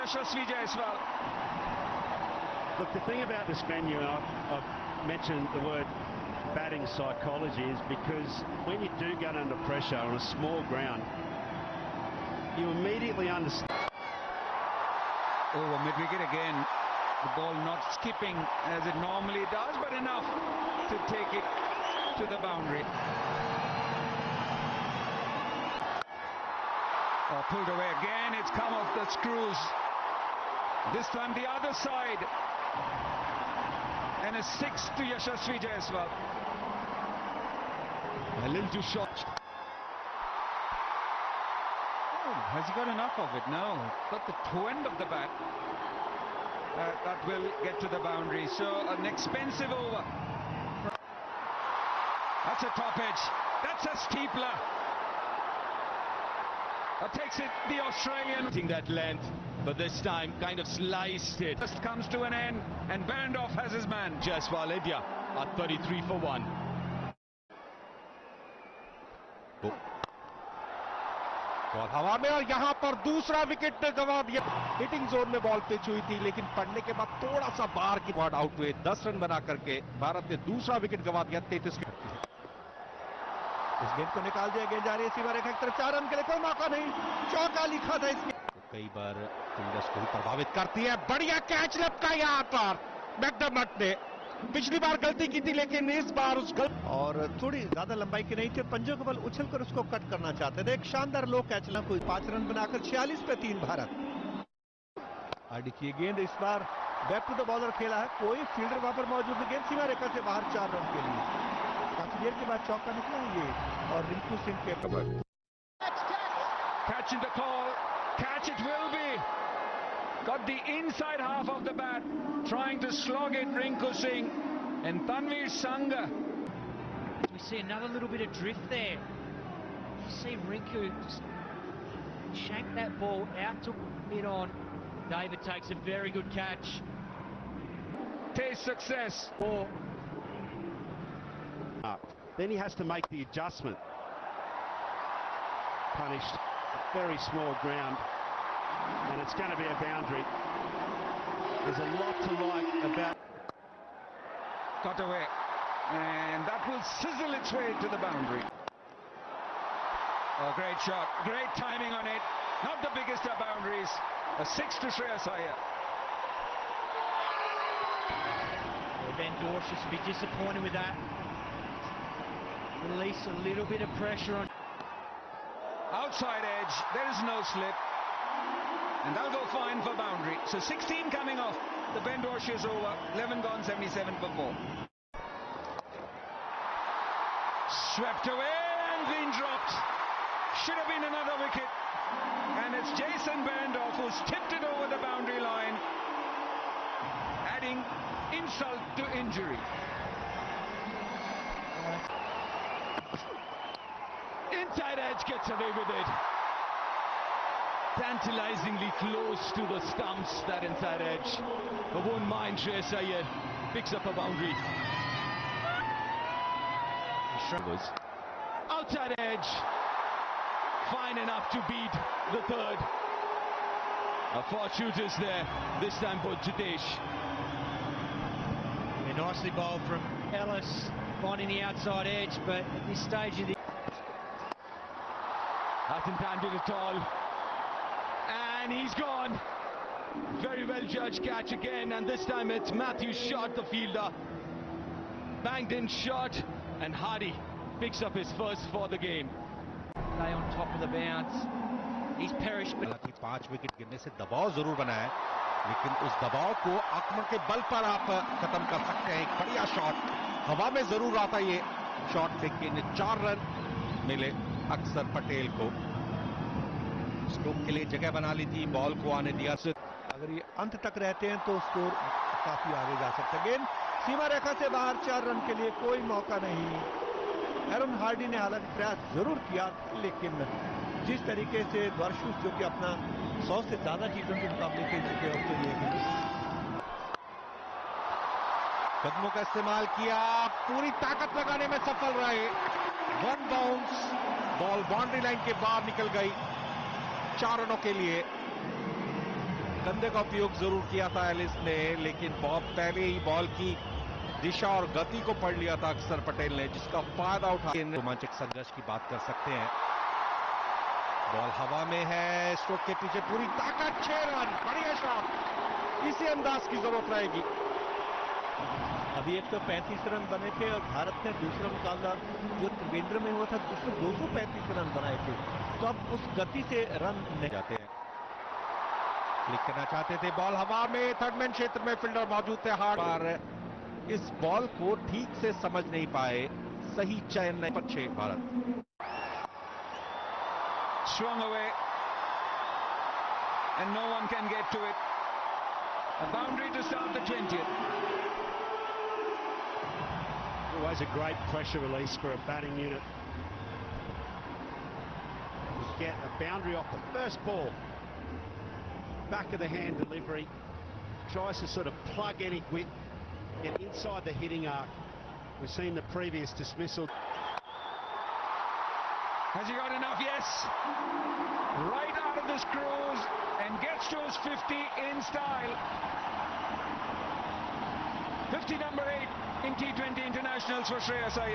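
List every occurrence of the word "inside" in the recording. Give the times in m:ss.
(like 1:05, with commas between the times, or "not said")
2:00, 3:24, 3:30, 6:03.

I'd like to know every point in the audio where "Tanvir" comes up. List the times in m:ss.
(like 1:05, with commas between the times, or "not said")
2:05.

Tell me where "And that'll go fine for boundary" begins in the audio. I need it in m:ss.
2:59.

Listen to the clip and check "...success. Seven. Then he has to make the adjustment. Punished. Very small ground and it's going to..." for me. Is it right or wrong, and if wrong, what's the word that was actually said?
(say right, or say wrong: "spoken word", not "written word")
wrong: "Four", not "Seven".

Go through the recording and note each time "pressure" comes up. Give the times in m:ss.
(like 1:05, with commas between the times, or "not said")
0:09, 2:53, 5:51.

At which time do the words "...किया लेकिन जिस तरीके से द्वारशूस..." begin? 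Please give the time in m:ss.
4:39.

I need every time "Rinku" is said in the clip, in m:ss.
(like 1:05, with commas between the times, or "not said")
2:03, 2:10.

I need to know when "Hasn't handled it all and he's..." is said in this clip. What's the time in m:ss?
3:55.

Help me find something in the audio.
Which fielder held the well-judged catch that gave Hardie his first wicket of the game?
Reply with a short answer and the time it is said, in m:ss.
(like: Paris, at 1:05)
Matthew Short, at 4:02.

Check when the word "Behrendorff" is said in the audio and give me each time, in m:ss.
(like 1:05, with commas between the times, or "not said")
1:03, 3:13.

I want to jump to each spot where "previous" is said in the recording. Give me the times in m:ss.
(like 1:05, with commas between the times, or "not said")
6:06.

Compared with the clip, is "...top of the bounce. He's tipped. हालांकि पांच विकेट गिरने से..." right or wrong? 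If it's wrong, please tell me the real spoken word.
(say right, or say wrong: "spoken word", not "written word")
wrong: "perished", not "tipped".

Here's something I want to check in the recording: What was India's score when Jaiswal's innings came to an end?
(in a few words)
33 for 1.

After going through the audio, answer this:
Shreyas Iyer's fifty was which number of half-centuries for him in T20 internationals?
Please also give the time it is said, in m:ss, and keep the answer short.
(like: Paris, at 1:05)
8, at 6:18.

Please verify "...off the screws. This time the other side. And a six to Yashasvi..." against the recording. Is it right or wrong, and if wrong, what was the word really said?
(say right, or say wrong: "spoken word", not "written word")
right.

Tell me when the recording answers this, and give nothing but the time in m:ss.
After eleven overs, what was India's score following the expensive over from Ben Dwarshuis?
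3:03.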